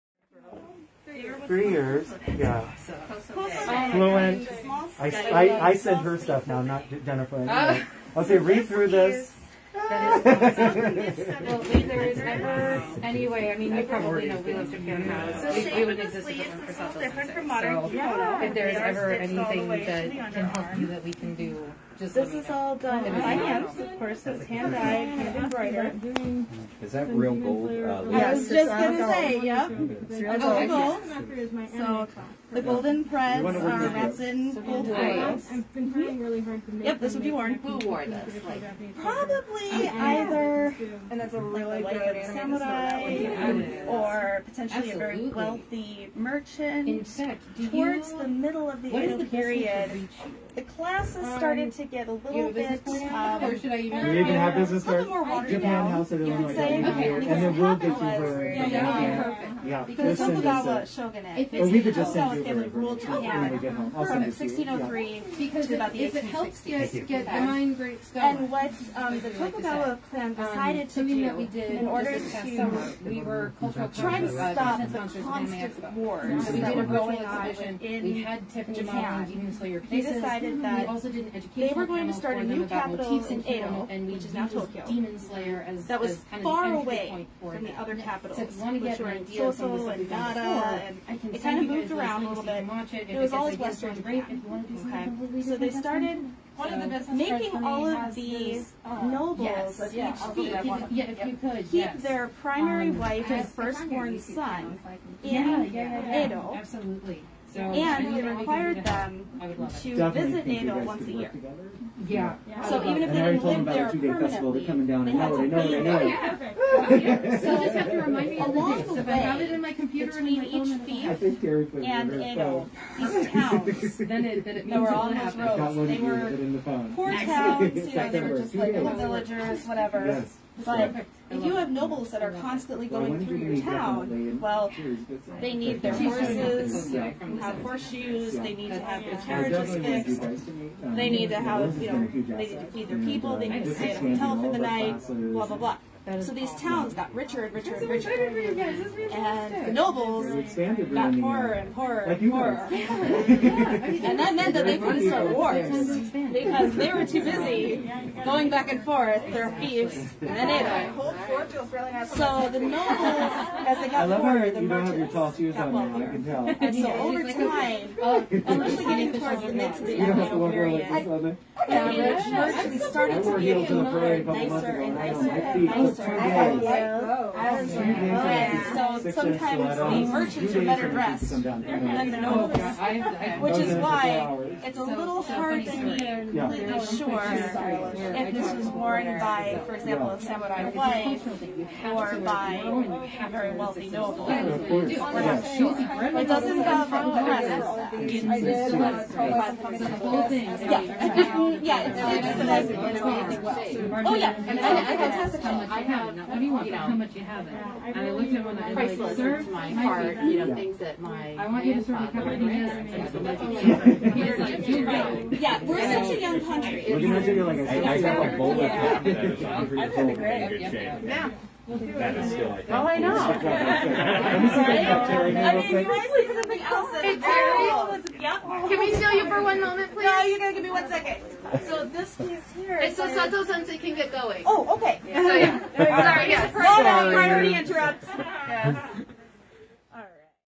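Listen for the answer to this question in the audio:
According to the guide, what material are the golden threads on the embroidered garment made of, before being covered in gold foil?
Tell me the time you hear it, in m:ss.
0:33.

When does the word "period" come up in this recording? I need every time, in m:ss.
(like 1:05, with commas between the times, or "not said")
0:49, 2:50.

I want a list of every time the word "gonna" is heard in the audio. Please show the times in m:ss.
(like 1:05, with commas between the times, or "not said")
0:28, 3:36.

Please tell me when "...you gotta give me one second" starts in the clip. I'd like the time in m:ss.
3:50.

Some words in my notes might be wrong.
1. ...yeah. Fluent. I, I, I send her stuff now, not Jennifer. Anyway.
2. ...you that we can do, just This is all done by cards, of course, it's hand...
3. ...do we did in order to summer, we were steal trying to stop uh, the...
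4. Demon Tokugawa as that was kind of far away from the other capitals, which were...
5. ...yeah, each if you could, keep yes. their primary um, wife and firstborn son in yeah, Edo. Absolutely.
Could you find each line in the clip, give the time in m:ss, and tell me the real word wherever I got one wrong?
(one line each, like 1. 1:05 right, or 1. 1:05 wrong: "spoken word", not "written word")
1. 0:02 right
2. 0:20 wrong: "hands", not "cards"
3. 1:11 wrong: "cultural", not "steal"
4. 1:24 wrong: "Slayer", not "Tokugawa"
5. 1:39 right.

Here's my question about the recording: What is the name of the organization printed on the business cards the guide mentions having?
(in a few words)
Japan House of Illinois.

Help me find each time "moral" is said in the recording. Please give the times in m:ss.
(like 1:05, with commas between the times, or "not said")
not said.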